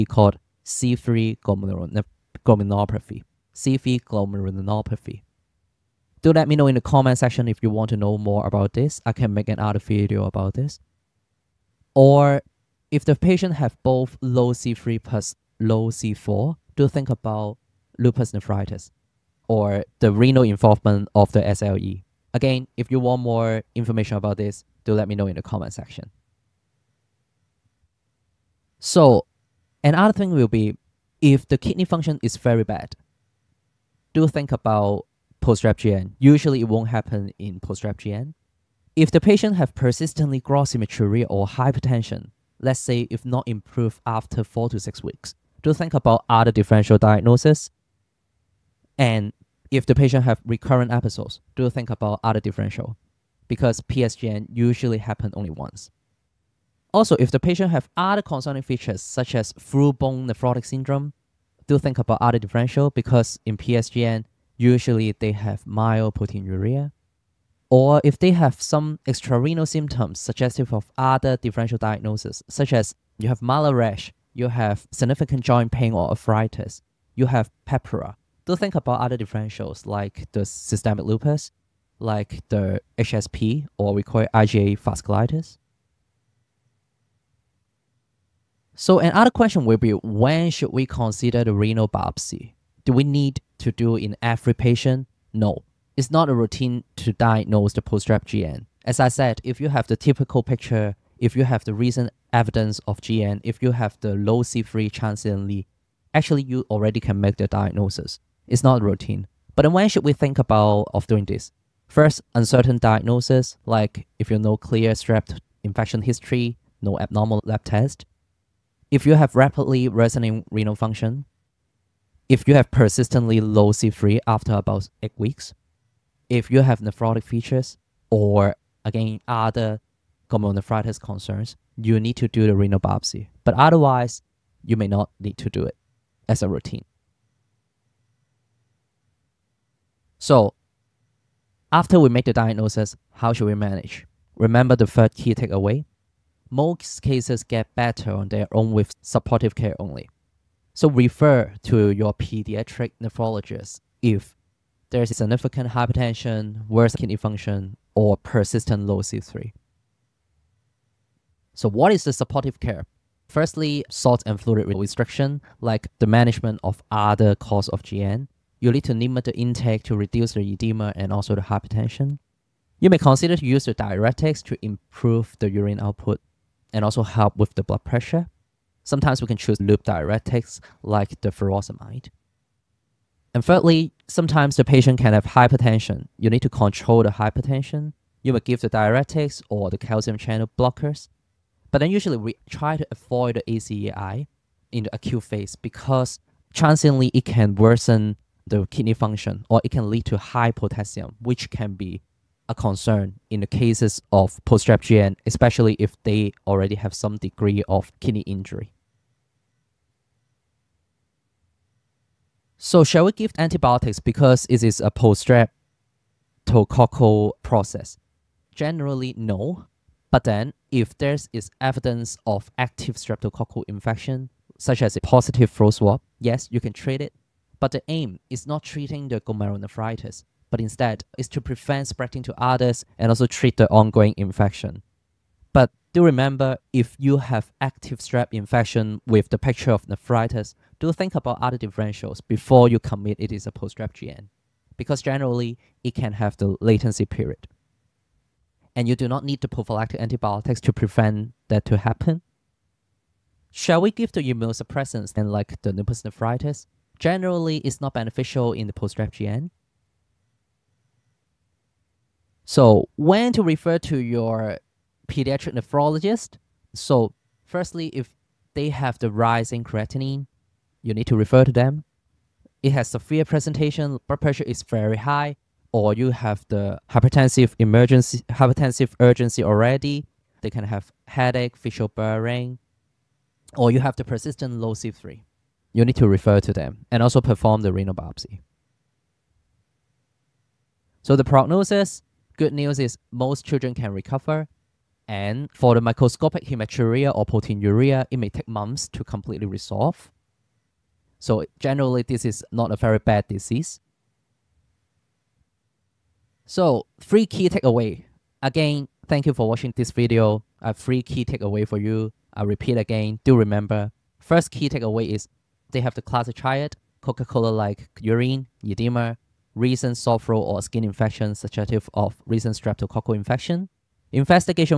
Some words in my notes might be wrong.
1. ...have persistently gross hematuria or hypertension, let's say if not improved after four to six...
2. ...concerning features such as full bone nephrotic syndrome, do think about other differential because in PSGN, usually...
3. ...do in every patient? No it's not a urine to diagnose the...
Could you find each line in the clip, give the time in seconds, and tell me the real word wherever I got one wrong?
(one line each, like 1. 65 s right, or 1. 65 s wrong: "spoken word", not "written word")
1. 39 s right
2. 58 s right
3. 93 s wrong: "routine", not "urine".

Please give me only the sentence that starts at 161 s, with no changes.
So what is the supportive care?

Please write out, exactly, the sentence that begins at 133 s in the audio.
But otherwise, you may not need to do it as a routine.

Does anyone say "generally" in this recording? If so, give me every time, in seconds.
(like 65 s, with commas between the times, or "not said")
218 s, 245 s, 256 s, 301 s.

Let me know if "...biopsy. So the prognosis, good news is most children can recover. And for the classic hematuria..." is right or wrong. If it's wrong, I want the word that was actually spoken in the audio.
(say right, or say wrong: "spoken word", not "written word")
wrong: "microscopic", not "classic".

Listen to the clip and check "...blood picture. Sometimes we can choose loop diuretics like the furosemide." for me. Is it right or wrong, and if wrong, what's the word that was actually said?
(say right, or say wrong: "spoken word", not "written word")
wrong: "pressure", not "picture".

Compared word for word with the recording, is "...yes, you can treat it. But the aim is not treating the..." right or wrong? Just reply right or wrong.
right.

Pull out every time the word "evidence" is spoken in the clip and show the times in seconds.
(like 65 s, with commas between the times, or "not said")
102 s, 221 s.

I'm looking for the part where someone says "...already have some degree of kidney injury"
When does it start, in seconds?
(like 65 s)
206 s.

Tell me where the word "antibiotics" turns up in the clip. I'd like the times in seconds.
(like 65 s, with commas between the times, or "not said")
213 s, 250 s.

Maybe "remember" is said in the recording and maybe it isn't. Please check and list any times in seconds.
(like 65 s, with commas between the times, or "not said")
144 s, 236 s, 313 s.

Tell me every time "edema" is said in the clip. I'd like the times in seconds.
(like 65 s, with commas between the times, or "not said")
170 s, 318 s.